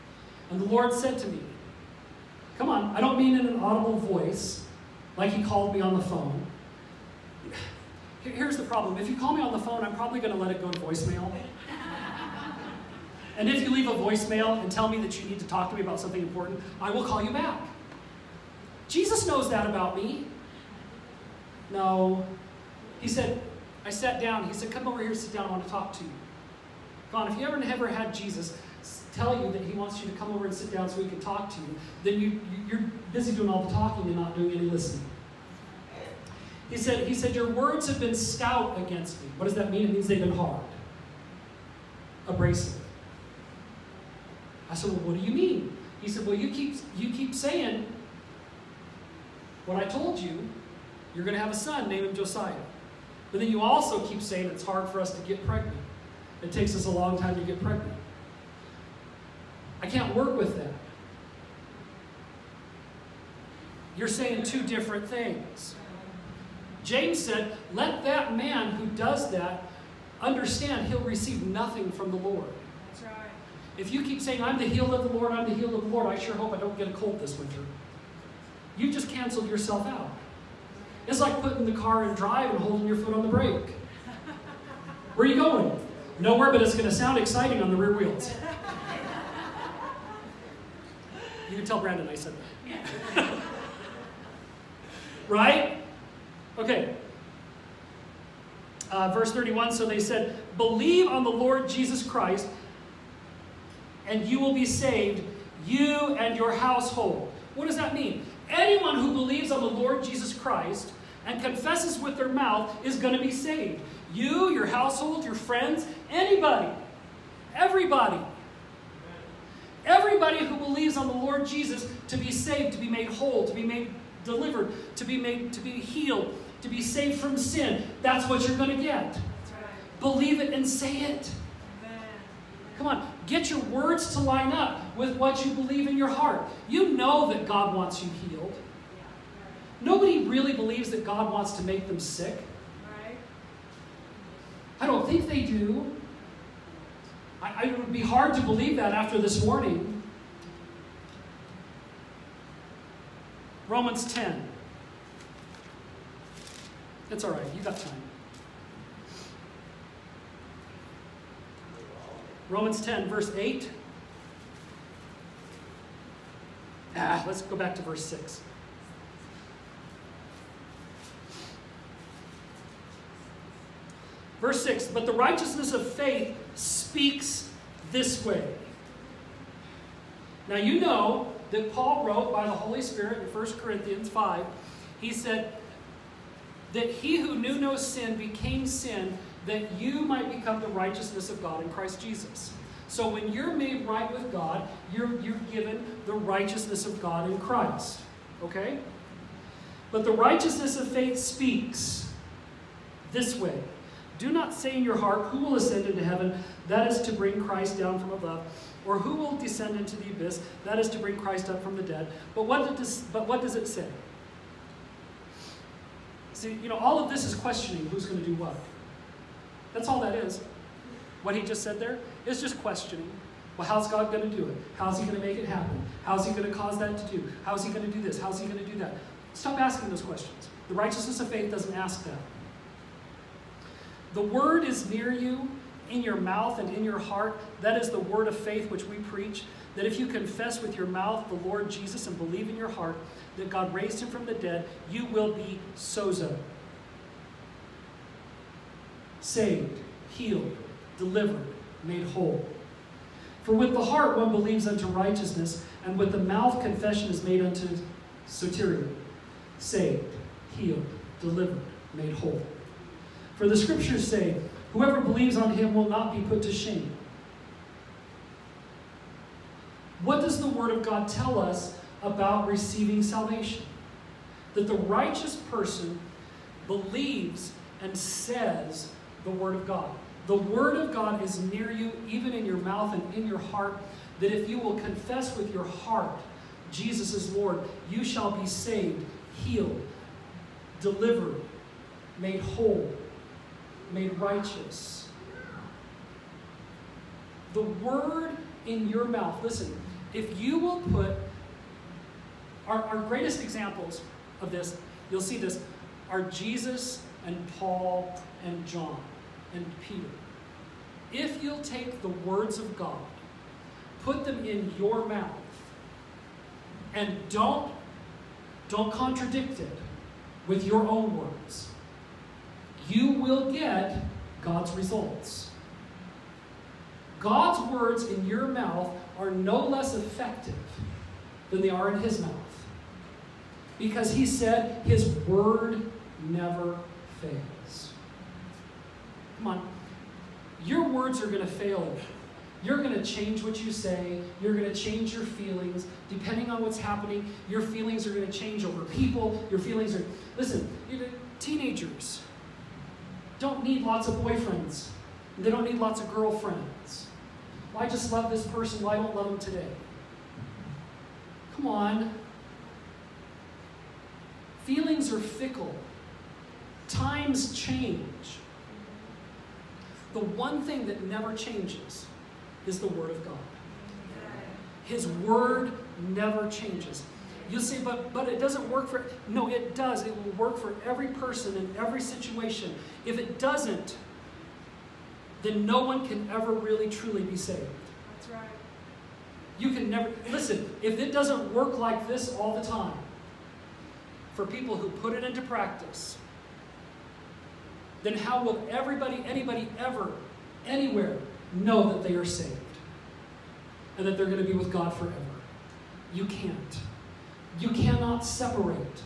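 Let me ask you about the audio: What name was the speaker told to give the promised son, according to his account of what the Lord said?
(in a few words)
Josiah.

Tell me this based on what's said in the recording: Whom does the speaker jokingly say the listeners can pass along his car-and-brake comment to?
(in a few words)
Brandon.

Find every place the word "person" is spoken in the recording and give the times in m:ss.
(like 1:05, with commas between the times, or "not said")
4:35, 5:58, 6:21.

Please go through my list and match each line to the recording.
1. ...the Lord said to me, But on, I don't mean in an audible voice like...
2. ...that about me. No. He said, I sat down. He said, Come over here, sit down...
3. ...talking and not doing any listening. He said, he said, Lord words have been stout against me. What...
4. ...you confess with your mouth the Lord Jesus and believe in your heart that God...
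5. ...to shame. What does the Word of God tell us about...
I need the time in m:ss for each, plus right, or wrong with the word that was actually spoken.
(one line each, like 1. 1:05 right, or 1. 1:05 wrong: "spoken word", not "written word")
1. 0:00 wrong: "Come", not "But"
2. 0:19 right
3. 0:33 wrong: "Your", not "Lord"
4. 3:59 right
5. 4:26 right.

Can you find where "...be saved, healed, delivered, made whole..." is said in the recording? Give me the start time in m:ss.
4:48.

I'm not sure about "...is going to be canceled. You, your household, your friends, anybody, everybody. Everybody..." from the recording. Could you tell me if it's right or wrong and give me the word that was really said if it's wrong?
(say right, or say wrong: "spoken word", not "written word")
wrong: "saved", not "canceled".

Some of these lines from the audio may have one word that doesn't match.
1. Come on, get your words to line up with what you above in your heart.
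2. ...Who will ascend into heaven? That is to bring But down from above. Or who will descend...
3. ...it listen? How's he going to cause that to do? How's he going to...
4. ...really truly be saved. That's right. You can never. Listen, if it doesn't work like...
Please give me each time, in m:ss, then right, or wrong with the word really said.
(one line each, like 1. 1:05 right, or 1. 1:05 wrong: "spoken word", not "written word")
1. 2:12 wrong: "believe", not "above"
2. 3:25 wrong: "Christ", not "But"
3. 3:45 wrong: "happen", not "listen"
4. 6:26 right.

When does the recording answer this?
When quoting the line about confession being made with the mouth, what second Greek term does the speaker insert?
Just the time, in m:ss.
4:18.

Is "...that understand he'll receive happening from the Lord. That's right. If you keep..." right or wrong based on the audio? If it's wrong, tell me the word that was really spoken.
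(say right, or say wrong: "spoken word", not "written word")
wrong: "nothing", not "happening".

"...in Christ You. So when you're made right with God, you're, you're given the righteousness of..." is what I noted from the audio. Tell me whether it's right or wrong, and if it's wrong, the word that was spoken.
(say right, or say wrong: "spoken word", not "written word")
wrong: "Jesus", not "You".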